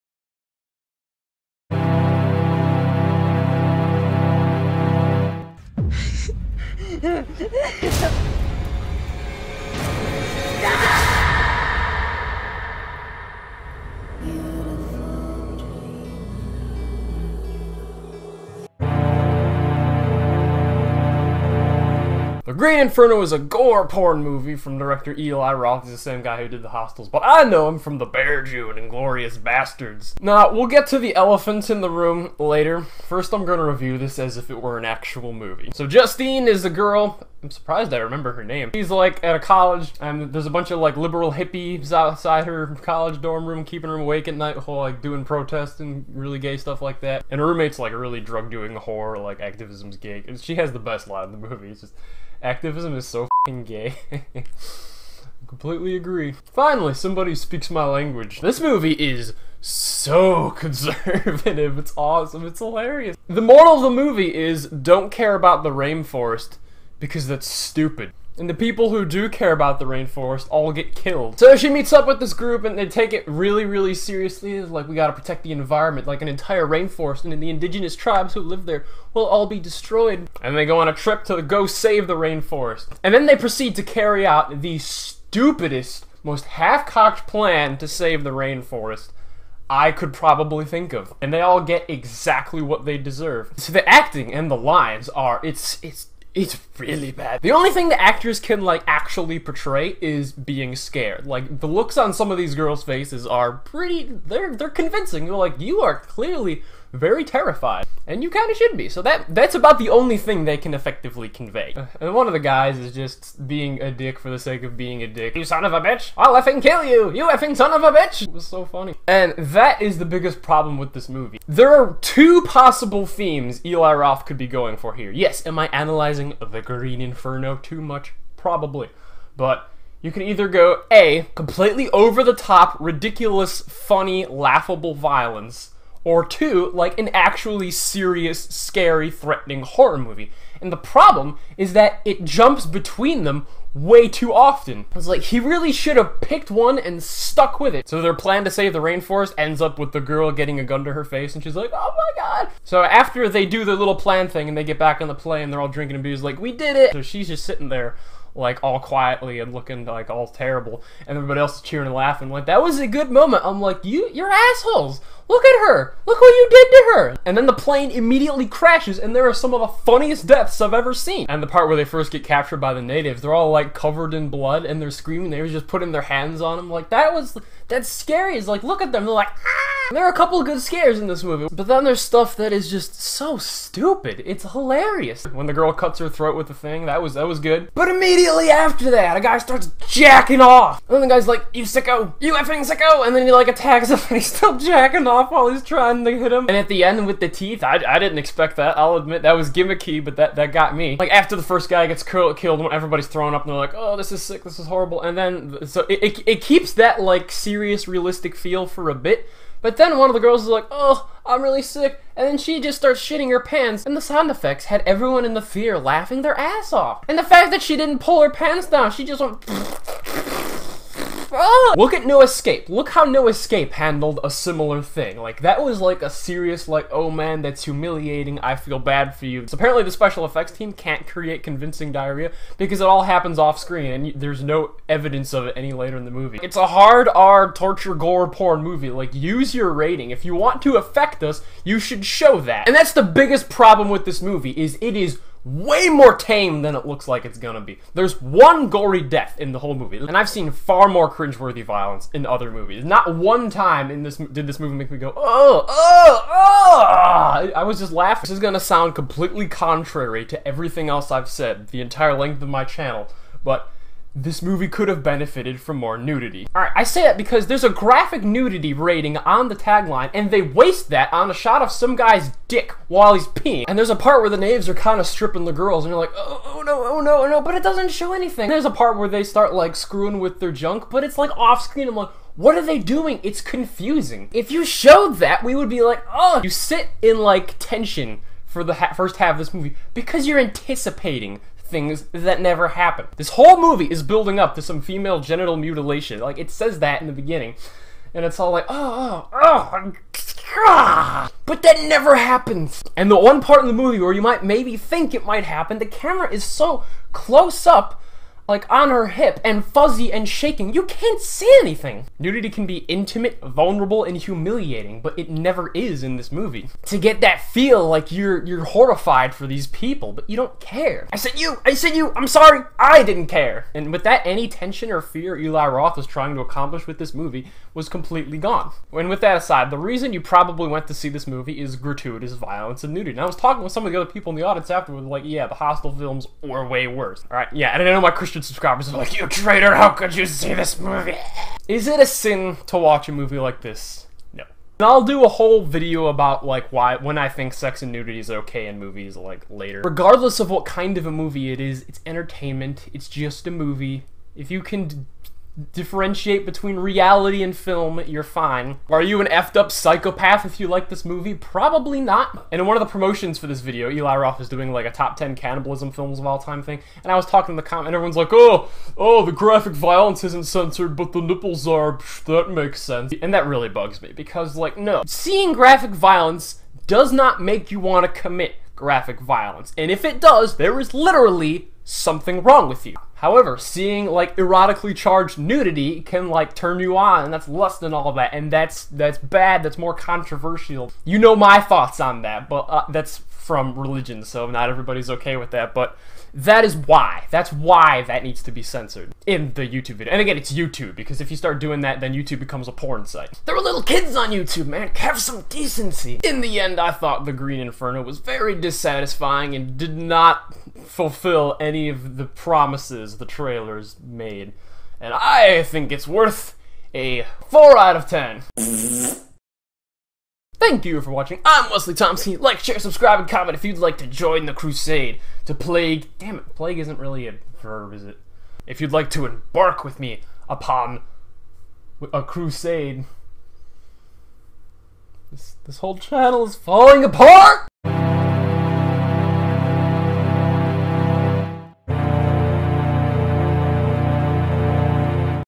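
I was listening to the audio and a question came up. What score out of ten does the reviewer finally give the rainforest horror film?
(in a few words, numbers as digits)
4.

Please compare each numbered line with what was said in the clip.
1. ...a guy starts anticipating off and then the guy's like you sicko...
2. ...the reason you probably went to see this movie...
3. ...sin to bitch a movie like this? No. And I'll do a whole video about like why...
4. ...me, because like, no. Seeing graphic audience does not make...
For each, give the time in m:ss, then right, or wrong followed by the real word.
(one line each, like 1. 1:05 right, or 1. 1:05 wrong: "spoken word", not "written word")
1. 3:09 wrong: "jacking", not "anticipating"
2. 5:29 right
3. 5:42 wrong: "watch", not "bitch"
4. 6:14 wrong: "violence", not "audience".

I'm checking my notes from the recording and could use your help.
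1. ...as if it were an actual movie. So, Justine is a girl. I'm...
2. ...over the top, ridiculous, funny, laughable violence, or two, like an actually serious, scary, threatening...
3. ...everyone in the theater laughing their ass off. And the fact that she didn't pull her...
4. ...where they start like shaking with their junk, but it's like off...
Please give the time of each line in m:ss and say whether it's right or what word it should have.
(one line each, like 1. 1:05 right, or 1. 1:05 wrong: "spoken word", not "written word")
1. 0:34 right
2. 2:11 right
3. 3:34 right
4. 4:38 wrong: "screwing", not "shaking".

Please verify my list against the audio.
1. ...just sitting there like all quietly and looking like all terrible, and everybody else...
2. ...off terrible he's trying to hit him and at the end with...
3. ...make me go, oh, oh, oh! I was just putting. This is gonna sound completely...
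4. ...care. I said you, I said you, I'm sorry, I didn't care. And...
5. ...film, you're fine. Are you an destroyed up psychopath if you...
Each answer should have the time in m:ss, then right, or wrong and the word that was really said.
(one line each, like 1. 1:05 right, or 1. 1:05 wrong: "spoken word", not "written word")
1. 2:37 right
2. 3:15 wrong: "while", not "terrible"
3. 4:14 wrong: "laughing", not "putting"
4. 5:20 right
5. 5:57 wrong: "effed", not "destroyed".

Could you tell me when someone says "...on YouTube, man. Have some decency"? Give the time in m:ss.
6:44.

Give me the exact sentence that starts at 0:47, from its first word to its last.
And her roommate's like a really drug doing whore, like activism's gig, and She has the best line in the movie.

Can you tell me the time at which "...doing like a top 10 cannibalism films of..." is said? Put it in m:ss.
6:04.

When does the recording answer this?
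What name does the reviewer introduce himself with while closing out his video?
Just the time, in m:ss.
7:01.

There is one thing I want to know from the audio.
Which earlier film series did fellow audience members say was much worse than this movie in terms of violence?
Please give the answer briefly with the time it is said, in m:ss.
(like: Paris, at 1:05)
The Hostel films, at 5:35.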